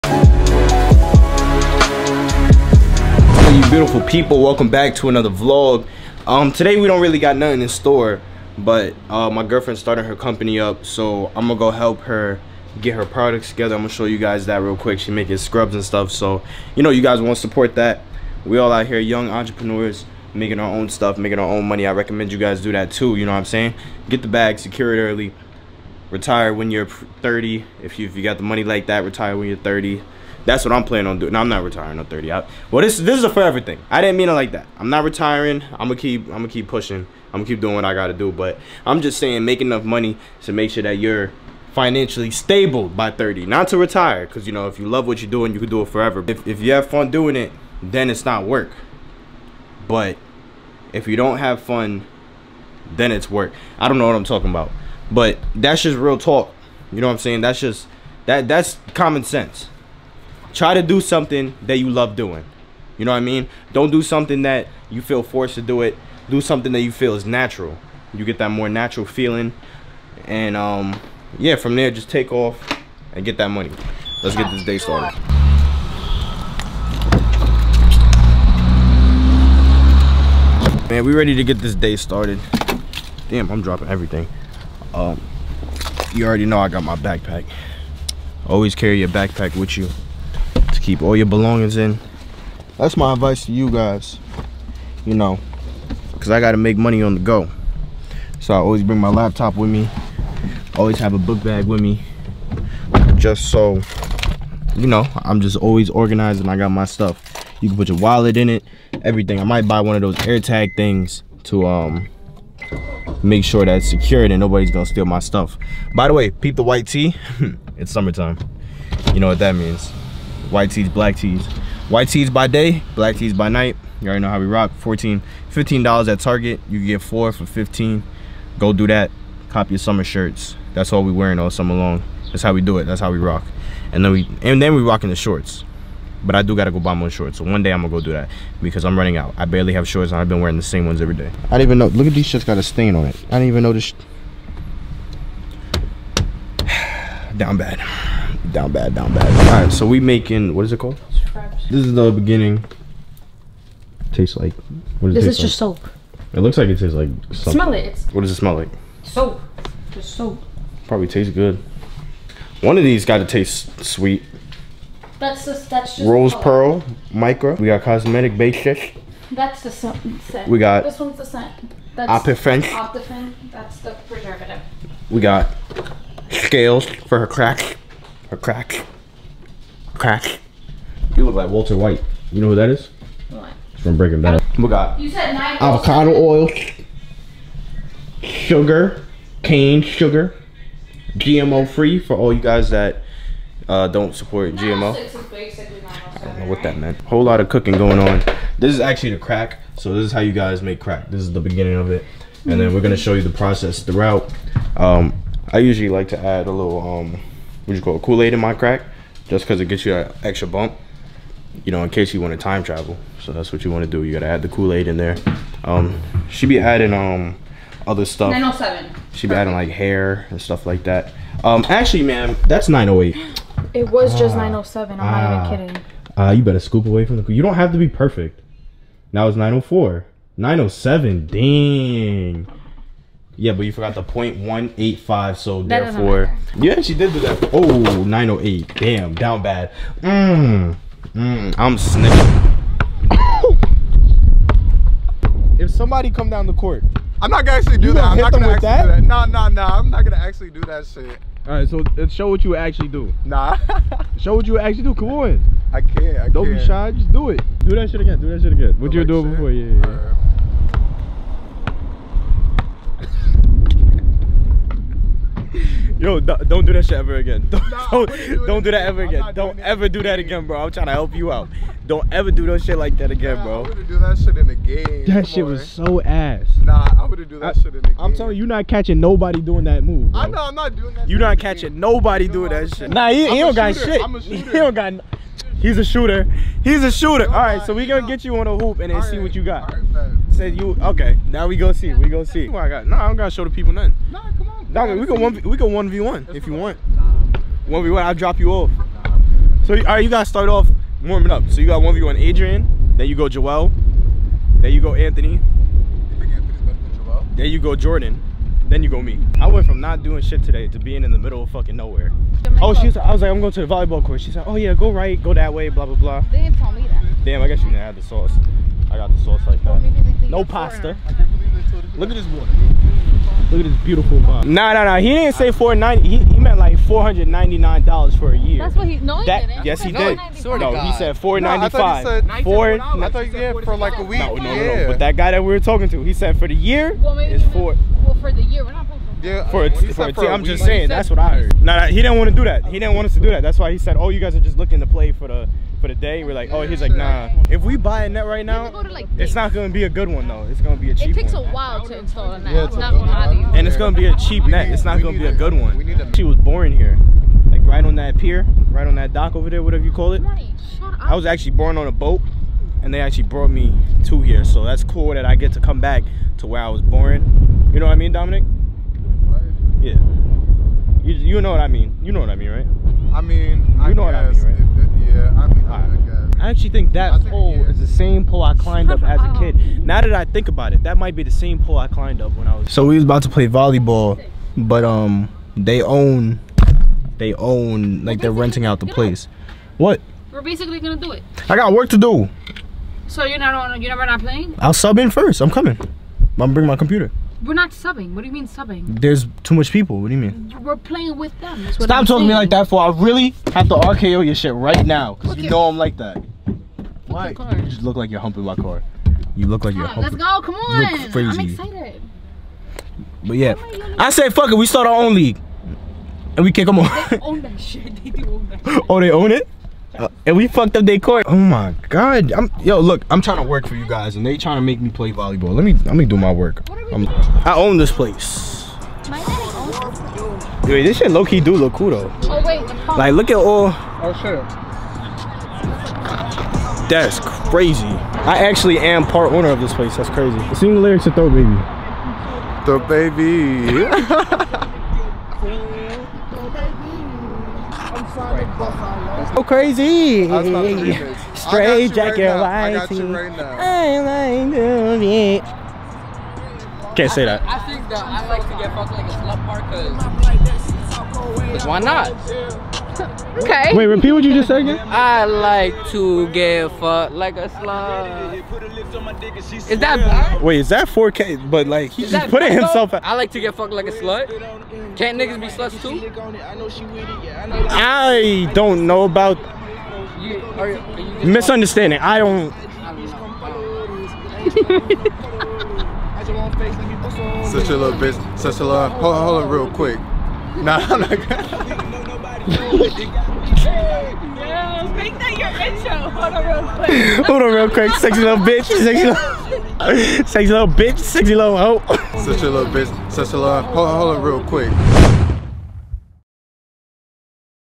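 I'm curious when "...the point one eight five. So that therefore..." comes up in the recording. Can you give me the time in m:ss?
3:53.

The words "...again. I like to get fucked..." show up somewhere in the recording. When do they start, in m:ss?
7:44.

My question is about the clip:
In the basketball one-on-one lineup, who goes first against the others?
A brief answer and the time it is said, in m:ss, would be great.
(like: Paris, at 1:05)
Adrian, at 5:02.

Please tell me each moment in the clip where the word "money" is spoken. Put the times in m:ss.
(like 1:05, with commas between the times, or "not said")
0:21, 0:28, 0:39, 1:13, 1:36.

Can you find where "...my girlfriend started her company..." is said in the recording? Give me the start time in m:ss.
0:09.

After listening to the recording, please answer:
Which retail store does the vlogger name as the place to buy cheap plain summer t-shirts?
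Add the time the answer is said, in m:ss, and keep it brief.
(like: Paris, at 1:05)
Target, at 2:06.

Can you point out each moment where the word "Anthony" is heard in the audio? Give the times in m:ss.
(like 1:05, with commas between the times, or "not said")
5:04.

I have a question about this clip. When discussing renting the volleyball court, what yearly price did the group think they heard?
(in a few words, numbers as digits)
$499.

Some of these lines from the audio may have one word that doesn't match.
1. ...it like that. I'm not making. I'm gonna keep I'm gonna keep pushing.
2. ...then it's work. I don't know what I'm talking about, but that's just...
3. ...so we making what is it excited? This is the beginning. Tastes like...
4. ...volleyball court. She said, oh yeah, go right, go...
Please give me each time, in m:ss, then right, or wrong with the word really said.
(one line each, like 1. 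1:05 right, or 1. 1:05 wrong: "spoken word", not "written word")
1. 0:34 wrong: "retiring", not "making"
2. 0:52 right
3. 2:29 wrong: "called", not "excited"
4. 5:13 right.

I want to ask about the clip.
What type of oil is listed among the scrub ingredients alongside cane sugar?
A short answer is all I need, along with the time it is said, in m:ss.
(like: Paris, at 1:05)
Avocado oil, at 3:05.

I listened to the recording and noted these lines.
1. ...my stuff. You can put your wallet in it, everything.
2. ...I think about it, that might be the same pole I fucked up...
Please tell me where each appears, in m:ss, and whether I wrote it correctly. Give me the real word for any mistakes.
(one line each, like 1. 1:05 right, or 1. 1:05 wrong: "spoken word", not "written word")
1. 1:46 right
2. 6:20 wrong: "climbed", not "fucked".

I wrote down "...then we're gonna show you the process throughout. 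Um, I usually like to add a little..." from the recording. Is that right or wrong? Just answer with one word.
right.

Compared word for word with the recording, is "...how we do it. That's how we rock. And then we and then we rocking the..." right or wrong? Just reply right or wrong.
right.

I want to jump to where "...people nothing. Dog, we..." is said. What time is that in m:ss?
4:53.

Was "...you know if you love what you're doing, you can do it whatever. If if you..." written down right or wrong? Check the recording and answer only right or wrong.
wrong.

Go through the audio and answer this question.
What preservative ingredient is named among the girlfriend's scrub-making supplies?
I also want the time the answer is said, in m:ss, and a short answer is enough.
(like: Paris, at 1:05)
Optiphen, at 2:53.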